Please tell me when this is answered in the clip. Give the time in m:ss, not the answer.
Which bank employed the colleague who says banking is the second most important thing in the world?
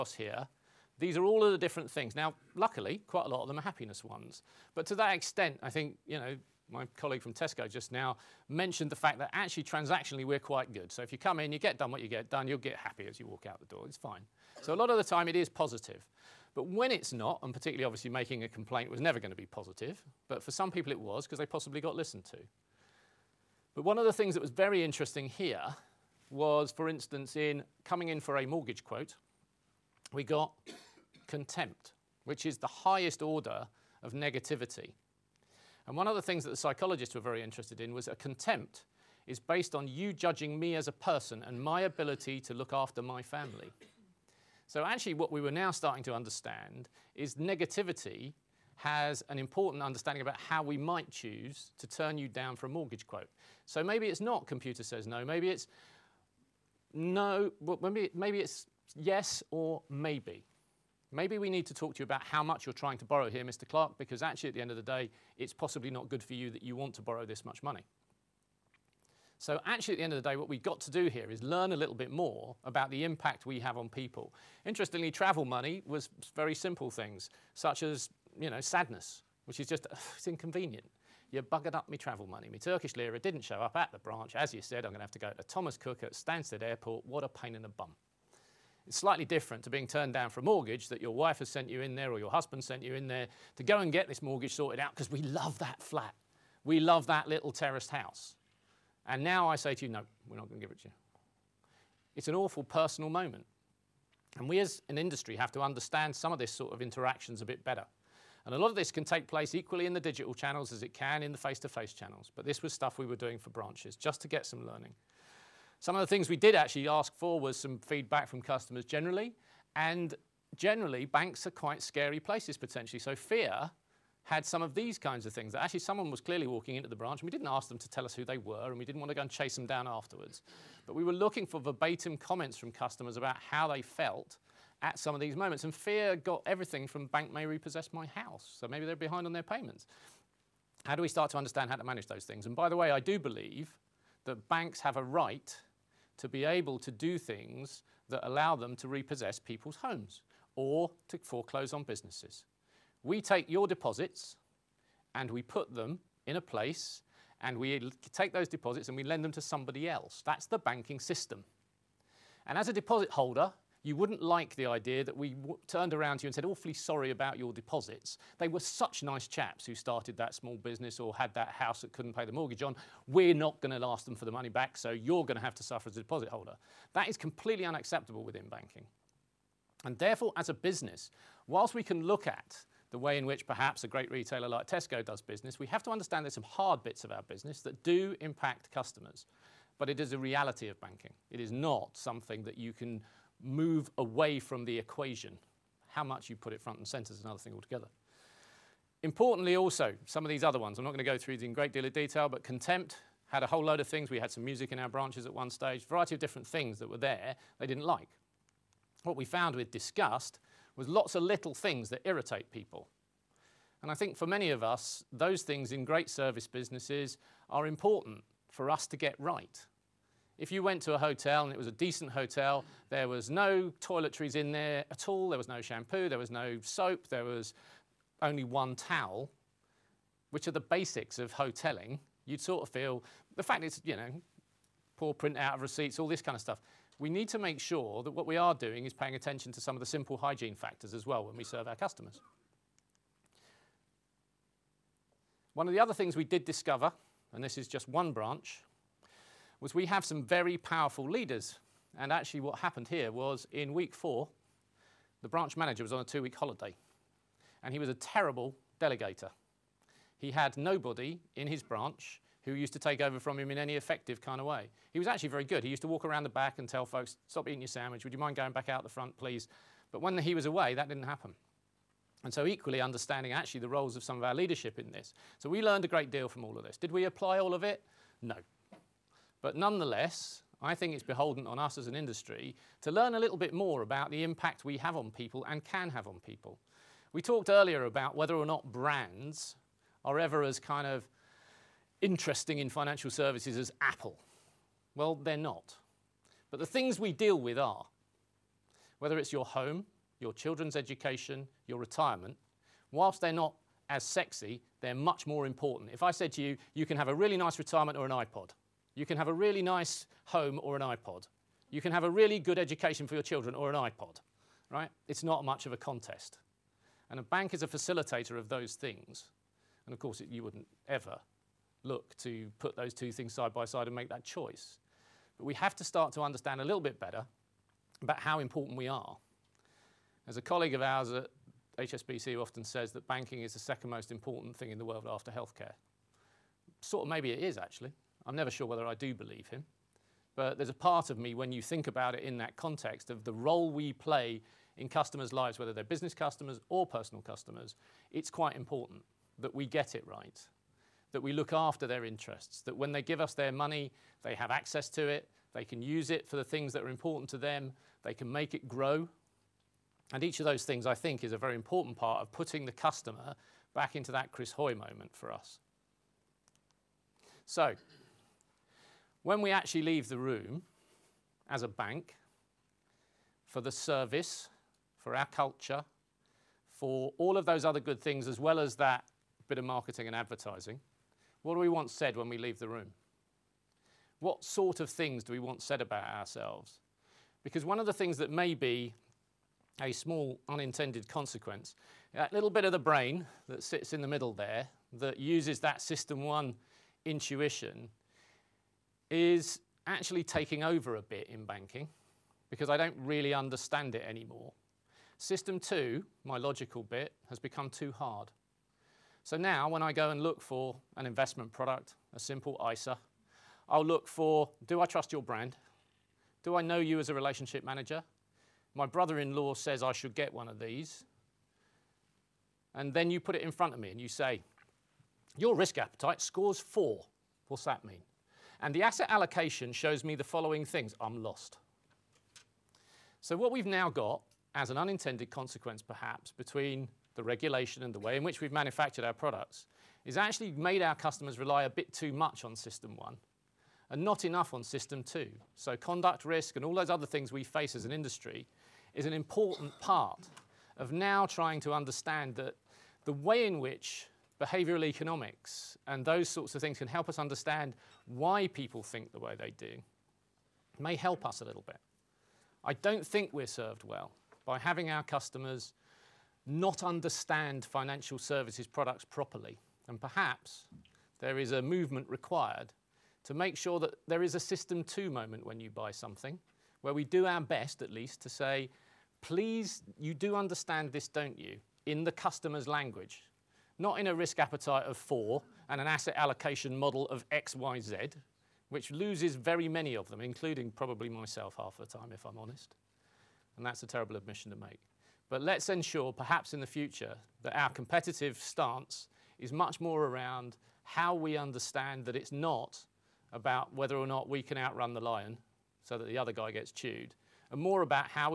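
5:31.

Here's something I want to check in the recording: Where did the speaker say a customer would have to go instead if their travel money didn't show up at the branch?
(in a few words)
Thomas Cook at Stansted Airport.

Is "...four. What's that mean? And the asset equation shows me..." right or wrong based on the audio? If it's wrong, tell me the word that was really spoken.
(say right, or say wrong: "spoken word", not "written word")
wrong: "allocation", not "equation".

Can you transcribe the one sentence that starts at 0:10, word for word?
So if you come in, you get done what you get done, you'll get happy as you walk out the door.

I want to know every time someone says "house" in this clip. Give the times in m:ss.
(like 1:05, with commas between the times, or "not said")
1:37, 2:18, 2:51.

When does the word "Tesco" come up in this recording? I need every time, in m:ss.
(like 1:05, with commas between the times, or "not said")
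0:07, 3:04.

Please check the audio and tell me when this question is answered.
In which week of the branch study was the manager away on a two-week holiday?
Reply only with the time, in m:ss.
4:13.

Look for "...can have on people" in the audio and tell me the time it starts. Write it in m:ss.
4:45.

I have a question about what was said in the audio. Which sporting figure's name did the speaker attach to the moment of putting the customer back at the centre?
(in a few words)
Chris Hoy.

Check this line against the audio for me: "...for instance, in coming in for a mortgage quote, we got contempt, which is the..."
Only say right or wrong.
right.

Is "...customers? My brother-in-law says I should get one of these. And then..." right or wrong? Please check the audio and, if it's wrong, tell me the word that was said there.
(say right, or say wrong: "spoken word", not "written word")
wrong: "manager", not "customers".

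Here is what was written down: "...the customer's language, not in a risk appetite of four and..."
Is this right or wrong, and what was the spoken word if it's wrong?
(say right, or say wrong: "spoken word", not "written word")
right.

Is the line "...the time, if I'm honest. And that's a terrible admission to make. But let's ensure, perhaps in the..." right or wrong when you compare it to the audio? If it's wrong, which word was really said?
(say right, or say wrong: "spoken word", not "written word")
right.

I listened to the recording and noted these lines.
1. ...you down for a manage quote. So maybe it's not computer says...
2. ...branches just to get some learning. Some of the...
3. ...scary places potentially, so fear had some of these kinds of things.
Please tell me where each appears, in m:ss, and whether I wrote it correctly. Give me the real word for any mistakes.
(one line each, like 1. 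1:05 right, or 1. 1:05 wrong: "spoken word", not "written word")
1. 0:52 wrong: "mortgage", not "manage"
2. 1:53 right
3. 2:01 right.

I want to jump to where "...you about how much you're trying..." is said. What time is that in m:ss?
1:01.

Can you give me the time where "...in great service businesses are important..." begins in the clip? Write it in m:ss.
3:35.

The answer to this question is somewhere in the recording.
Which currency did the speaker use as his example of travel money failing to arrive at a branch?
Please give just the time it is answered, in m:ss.
1:22.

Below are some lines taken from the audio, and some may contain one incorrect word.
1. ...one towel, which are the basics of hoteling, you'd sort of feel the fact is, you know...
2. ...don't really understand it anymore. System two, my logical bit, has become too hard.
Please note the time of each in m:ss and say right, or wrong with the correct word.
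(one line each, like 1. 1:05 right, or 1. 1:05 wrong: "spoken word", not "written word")
1. 3:48 right
2. 6:42 right.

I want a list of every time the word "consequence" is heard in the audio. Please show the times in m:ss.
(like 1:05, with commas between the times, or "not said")
6:31, 7:15.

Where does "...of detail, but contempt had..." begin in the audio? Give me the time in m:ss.
3:21.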